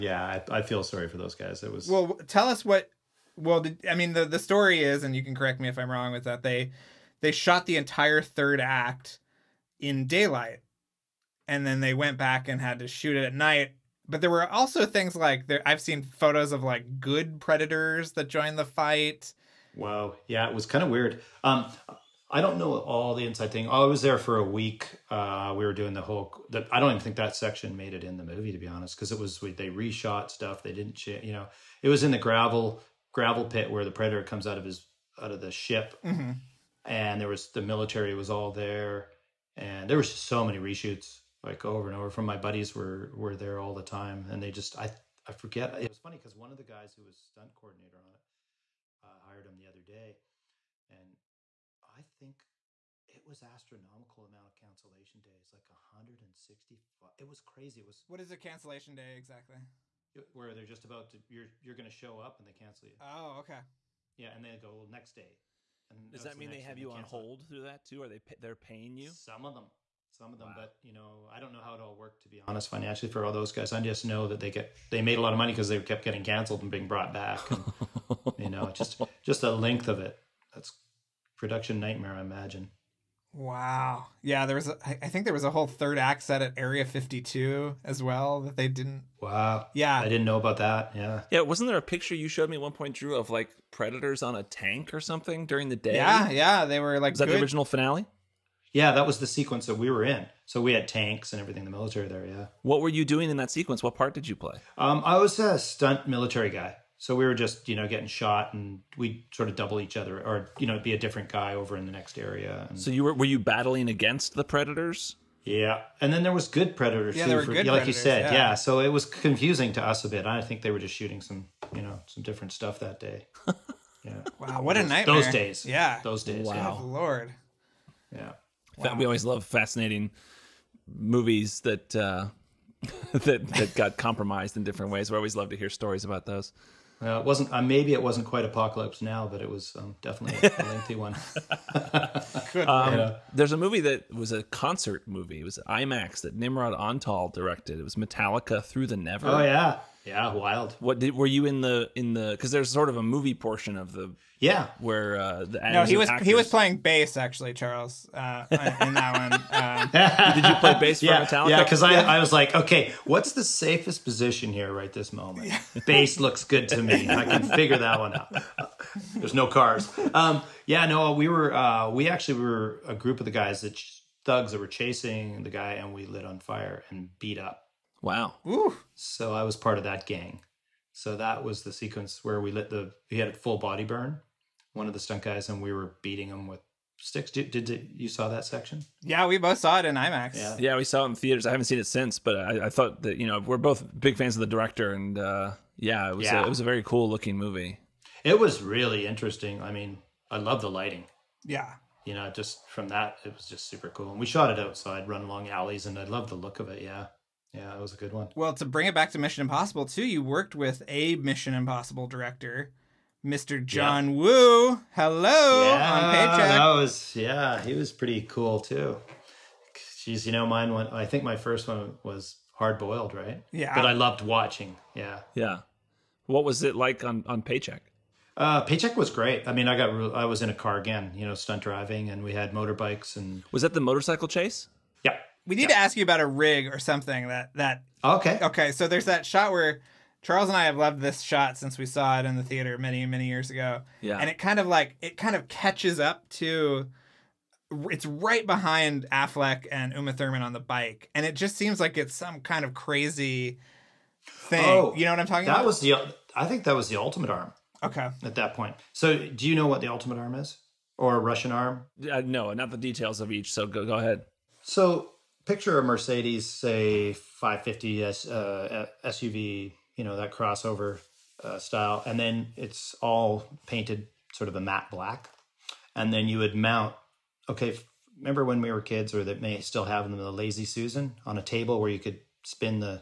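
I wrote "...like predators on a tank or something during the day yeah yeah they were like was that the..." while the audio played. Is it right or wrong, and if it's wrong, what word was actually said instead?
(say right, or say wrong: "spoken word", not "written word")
right.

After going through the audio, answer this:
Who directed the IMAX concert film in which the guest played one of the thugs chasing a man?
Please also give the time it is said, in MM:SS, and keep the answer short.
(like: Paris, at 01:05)
Nimrod Antal, at 02:26.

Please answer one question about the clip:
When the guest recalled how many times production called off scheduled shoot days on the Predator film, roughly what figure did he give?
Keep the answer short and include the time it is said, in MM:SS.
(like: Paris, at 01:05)
165, at 00:55.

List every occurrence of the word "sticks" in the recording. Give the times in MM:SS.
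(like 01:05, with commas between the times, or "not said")
03:06.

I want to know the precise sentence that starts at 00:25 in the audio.
Uh, we were doing the whole.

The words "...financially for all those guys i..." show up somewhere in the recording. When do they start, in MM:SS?
01:12.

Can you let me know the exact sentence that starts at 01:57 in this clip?
Yeah, too, there were for, good Like you said, yeah.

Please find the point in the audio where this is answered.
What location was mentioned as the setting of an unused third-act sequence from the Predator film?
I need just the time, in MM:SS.
01:26.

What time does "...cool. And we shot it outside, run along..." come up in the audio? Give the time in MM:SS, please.
03:23.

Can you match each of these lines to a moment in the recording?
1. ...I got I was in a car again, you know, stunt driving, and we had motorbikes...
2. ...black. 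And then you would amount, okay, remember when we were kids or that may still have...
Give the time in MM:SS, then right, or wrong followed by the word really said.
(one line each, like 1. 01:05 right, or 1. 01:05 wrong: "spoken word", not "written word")
1. 03:49 right
2. 04:34 wrong: "mount", not "amount".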